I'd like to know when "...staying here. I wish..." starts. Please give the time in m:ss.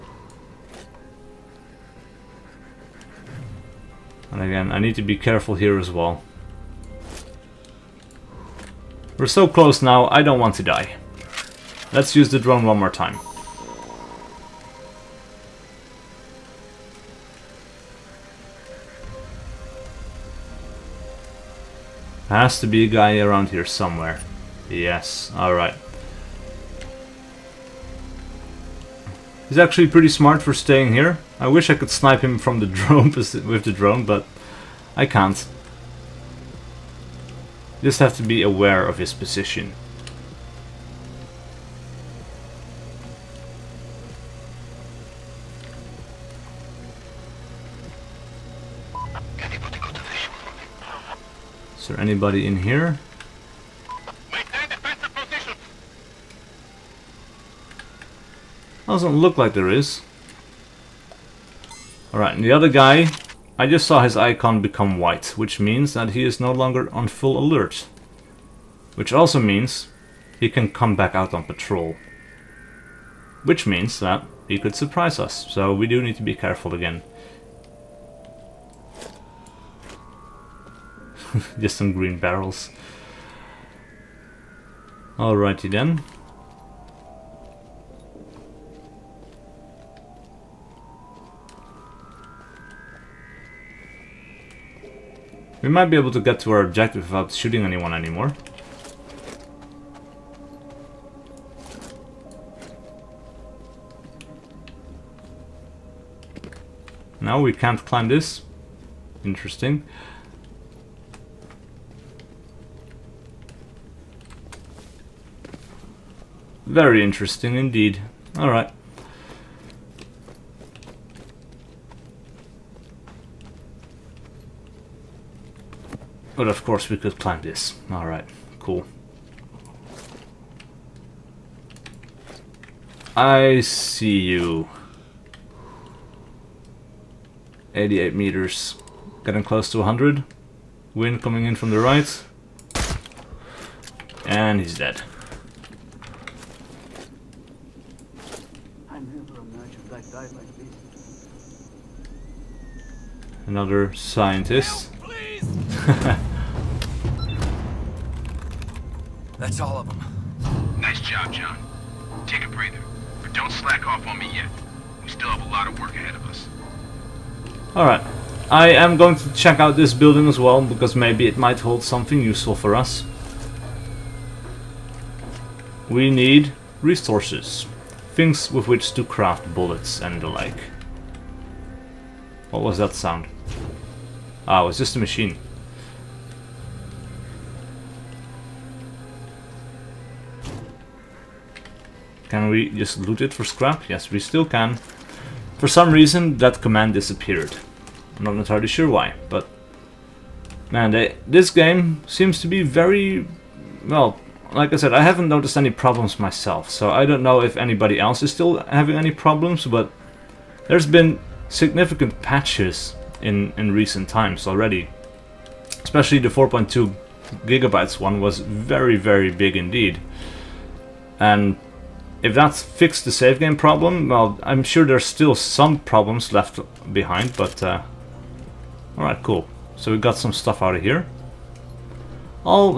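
0:30.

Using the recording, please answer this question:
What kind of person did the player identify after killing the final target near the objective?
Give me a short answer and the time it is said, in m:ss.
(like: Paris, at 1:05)
scientist, at 2:33.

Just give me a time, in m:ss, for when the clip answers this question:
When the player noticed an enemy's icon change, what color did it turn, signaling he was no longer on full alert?
1:04.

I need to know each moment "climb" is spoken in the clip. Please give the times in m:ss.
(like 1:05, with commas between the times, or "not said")
1:47, 2:07.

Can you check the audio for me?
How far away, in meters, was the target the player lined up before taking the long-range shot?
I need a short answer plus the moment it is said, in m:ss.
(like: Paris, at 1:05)
88 meters, at 2:17.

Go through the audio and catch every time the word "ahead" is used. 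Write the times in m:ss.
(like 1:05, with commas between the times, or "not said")
2:45.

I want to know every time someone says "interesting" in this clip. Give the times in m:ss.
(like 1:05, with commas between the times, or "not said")
1:49, 1:57.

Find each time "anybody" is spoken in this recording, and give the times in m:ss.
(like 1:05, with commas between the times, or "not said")
0:51, 3:27.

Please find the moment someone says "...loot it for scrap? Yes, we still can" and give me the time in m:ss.
3:12.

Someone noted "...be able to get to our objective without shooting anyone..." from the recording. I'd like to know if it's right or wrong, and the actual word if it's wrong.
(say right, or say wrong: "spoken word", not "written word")
right.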